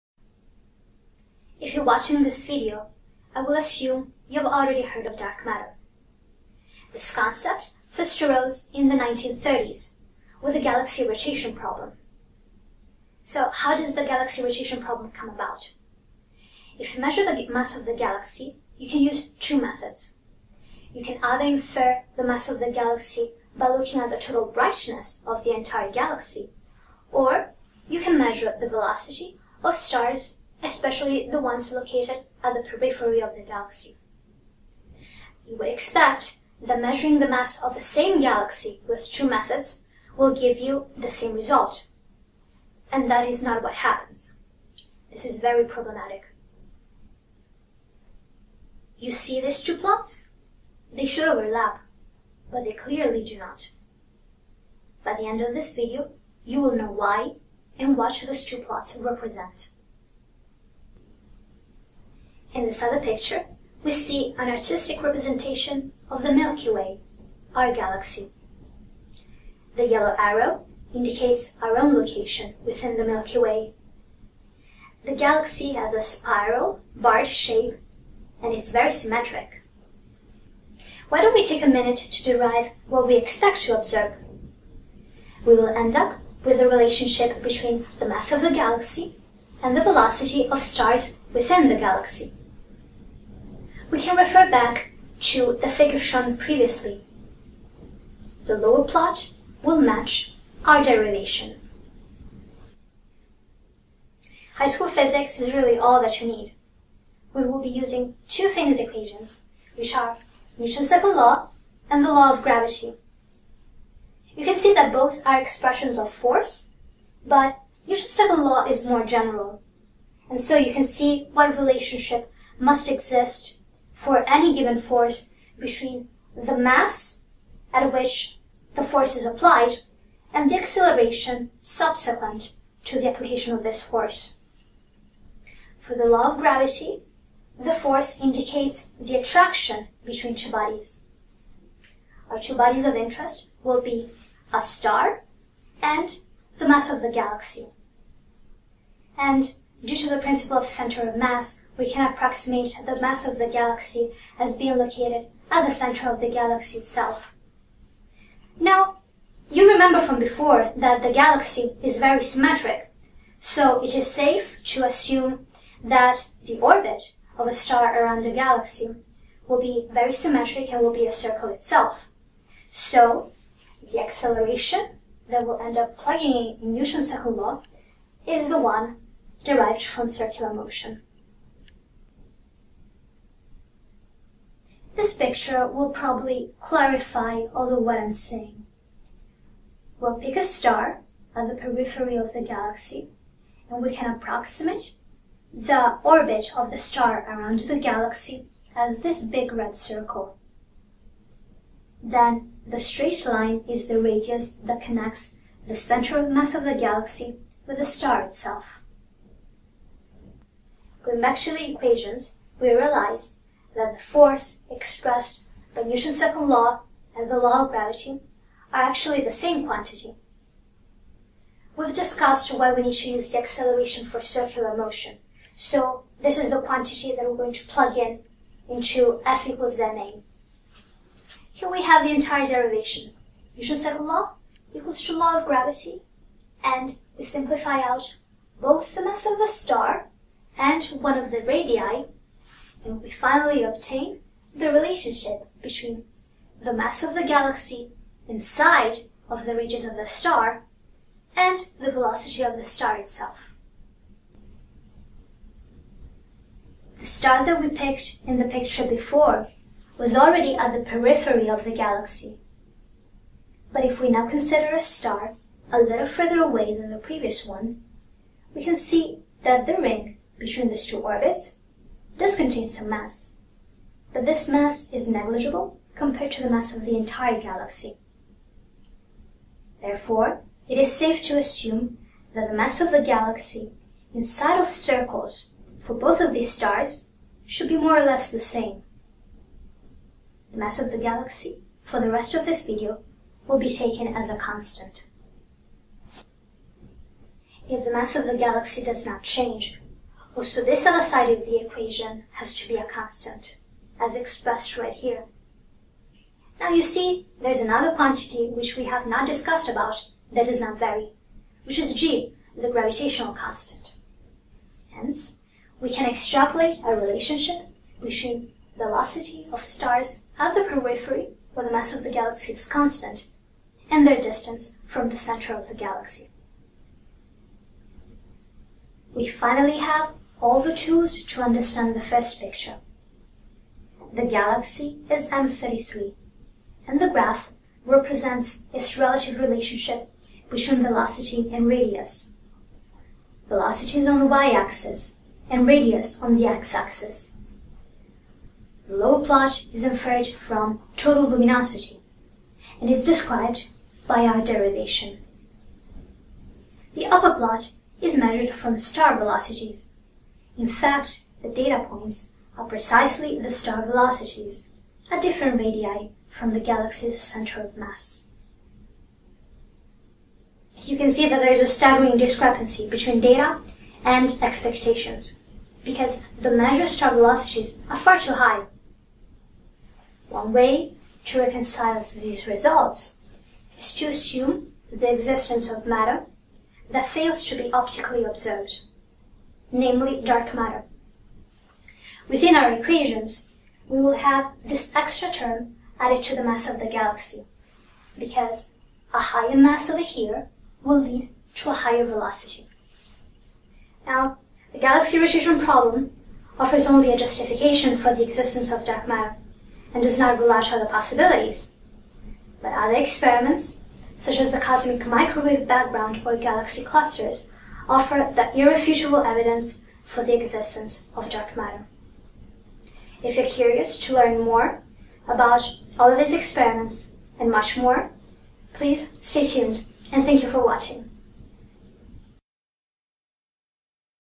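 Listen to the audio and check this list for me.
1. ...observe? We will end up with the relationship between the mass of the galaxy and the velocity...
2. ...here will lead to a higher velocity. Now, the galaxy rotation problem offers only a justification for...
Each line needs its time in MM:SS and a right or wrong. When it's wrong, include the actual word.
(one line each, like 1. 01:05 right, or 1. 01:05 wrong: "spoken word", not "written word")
1. 01:23 right
2. 06:40 right.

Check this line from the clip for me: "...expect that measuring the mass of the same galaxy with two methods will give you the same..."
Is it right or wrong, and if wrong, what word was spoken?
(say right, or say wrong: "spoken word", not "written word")
right.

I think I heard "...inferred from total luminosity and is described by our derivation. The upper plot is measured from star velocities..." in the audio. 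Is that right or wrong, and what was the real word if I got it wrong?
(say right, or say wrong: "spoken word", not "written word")
right.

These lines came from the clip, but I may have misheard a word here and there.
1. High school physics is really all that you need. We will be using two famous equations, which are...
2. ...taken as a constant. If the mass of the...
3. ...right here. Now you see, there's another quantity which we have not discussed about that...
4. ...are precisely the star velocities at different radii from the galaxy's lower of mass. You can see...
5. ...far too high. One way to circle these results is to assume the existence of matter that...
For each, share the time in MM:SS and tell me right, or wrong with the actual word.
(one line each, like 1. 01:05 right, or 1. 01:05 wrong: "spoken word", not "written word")
1. 01:44 right
2. 04:53 right
3. 05:04 right
4. 06:02 wrong: "center", not "lower"
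5. 06:17 wrong: "reconcile", not "circle".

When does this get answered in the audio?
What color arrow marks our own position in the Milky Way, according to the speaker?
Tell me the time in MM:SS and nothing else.
01:09.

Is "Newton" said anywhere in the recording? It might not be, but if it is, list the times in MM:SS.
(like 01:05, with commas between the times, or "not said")
01:50, 01:57, 02:56, 03:35, 03:53.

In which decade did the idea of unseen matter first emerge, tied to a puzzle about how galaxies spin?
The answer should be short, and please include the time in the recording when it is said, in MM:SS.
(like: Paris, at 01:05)
1930s, at 00:08.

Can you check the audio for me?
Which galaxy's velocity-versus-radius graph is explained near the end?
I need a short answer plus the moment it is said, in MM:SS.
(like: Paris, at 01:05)
M33, at 05:35.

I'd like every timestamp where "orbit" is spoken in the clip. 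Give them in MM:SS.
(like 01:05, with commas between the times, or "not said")
02:46, 03:16, 04:30.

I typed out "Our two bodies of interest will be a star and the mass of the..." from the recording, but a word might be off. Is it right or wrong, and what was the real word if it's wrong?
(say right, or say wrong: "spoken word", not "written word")
right.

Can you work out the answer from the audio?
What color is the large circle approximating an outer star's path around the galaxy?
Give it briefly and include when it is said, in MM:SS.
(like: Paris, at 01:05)
red, at 03:19.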